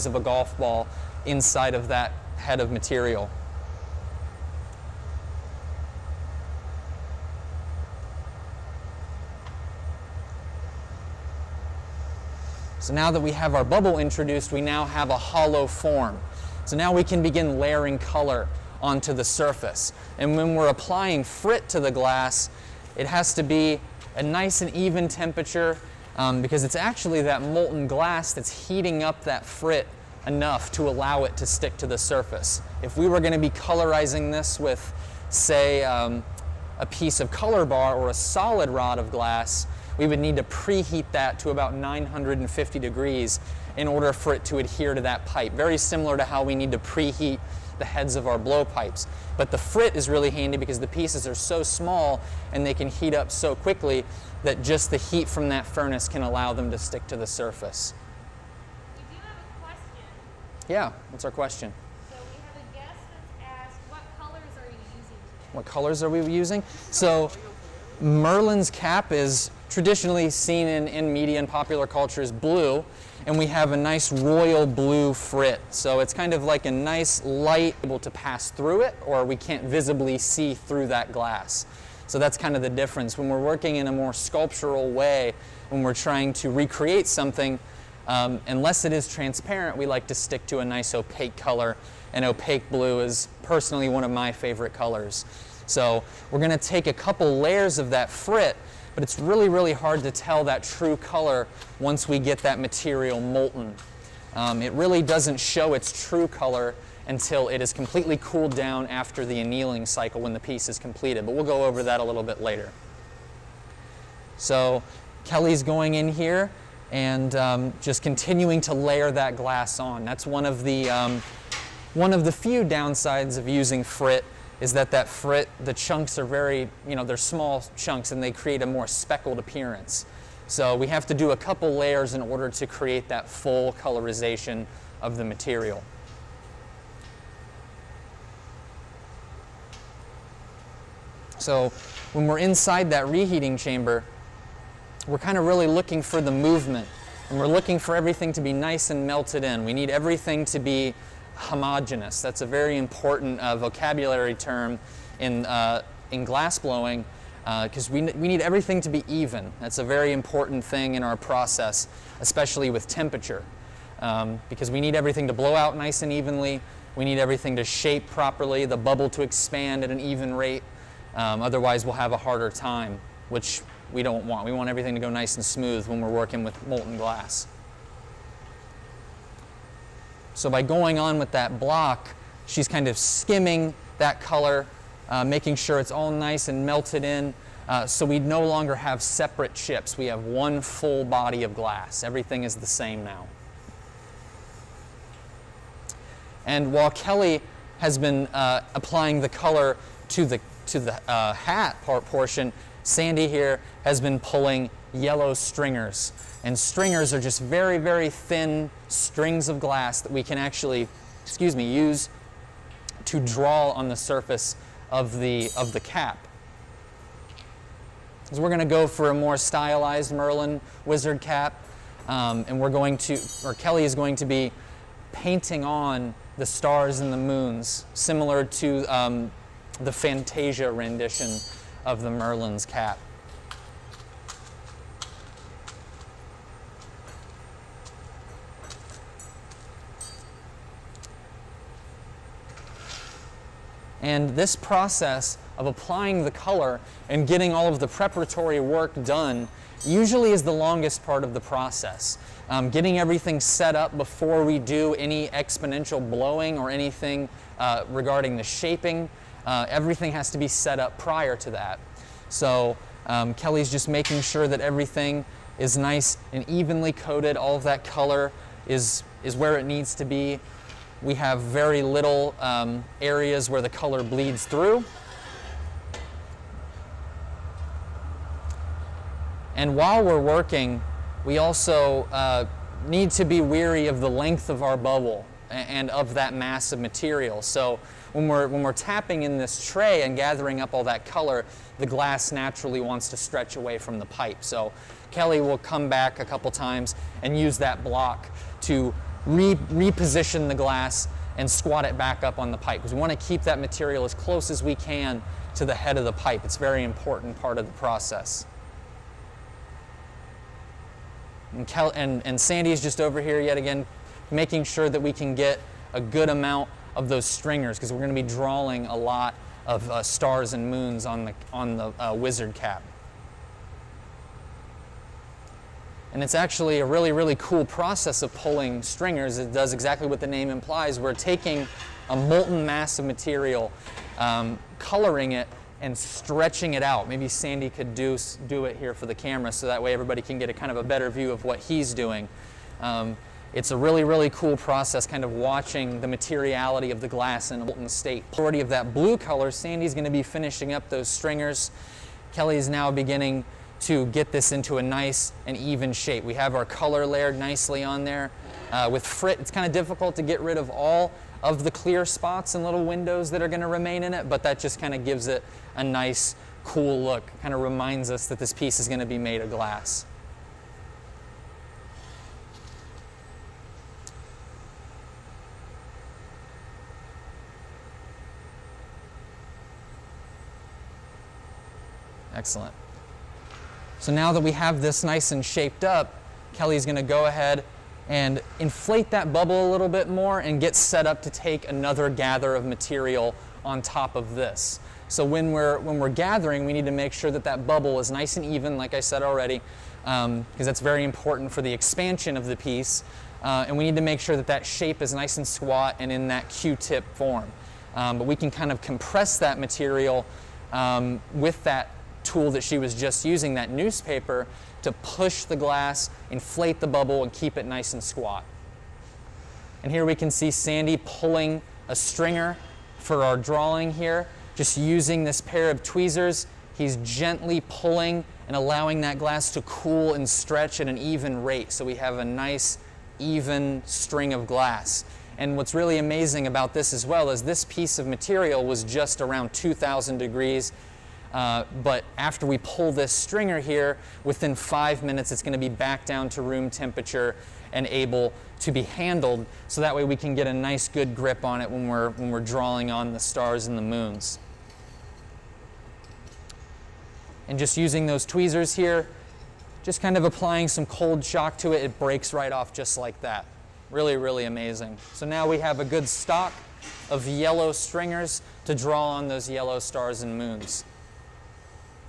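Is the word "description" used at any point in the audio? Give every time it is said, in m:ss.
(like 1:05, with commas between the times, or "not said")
not said.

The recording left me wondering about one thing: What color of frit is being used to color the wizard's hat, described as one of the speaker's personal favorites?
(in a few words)
Royal blue.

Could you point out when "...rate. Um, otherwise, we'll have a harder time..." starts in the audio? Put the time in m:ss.
2:50.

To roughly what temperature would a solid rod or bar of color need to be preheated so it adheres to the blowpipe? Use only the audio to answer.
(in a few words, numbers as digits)
950 degrees.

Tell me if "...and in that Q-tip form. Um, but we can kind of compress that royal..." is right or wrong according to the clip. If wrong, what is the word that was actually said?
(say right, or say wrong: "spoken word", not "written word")
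wrong: "material", not "royal".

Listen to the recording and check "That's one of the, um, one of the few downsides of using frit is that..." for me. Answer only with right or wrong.
right.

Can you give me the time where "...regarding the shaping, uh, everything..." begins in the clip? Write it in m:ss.
4:17.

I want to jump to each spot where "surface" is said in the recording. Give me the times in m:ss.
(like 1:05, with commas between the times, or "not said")
0:19, 0:31, 0:57, 3:33.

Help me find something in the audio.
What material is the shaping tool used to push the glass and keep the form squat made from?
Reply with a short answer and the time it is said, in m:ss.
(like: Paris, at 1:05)
Newspaper, at 6:53.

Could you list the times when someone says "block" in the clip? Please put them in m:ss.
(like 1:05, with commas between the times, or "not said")
3:01, 4:57.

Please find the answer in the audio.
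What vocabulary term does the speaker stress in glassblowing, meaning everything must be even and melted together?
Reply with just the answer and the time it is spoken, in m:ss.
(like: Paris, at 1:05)
Homogenous, at 2:31.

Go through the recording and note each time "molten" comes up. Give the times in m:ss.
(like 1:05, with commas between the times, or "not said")
0:27, 1:43, 2:56, 5:32, 5:47.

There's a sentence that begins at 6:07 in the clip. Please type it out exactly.
Kind of reminds us that this piece is going to be made of glass.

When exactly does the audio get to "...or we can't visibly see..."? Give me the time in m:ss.
1:19.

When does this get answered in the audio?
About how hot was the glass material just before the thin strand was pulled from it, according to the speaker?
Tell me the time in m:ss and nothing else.
7:19.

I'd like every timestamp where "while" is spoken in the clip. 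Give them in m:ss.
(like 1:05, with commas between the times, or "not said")
3:16, 4:39.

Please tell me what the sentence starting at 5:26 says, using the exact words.
And it's actually a really, really cool process of pulling stringers.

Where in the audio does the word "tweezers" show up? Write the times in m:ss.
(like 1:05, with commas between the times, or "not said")
7:05, 7:38.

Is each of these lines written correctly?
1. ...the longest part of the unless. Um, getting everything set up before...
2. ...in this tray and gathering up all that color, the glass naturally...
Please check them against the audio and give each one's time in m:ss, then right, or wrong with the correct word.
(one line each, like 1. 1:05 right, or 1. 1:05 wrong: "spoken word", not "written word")
1. 4:10 wrong: "process", not "unless"
2. 4:49 right.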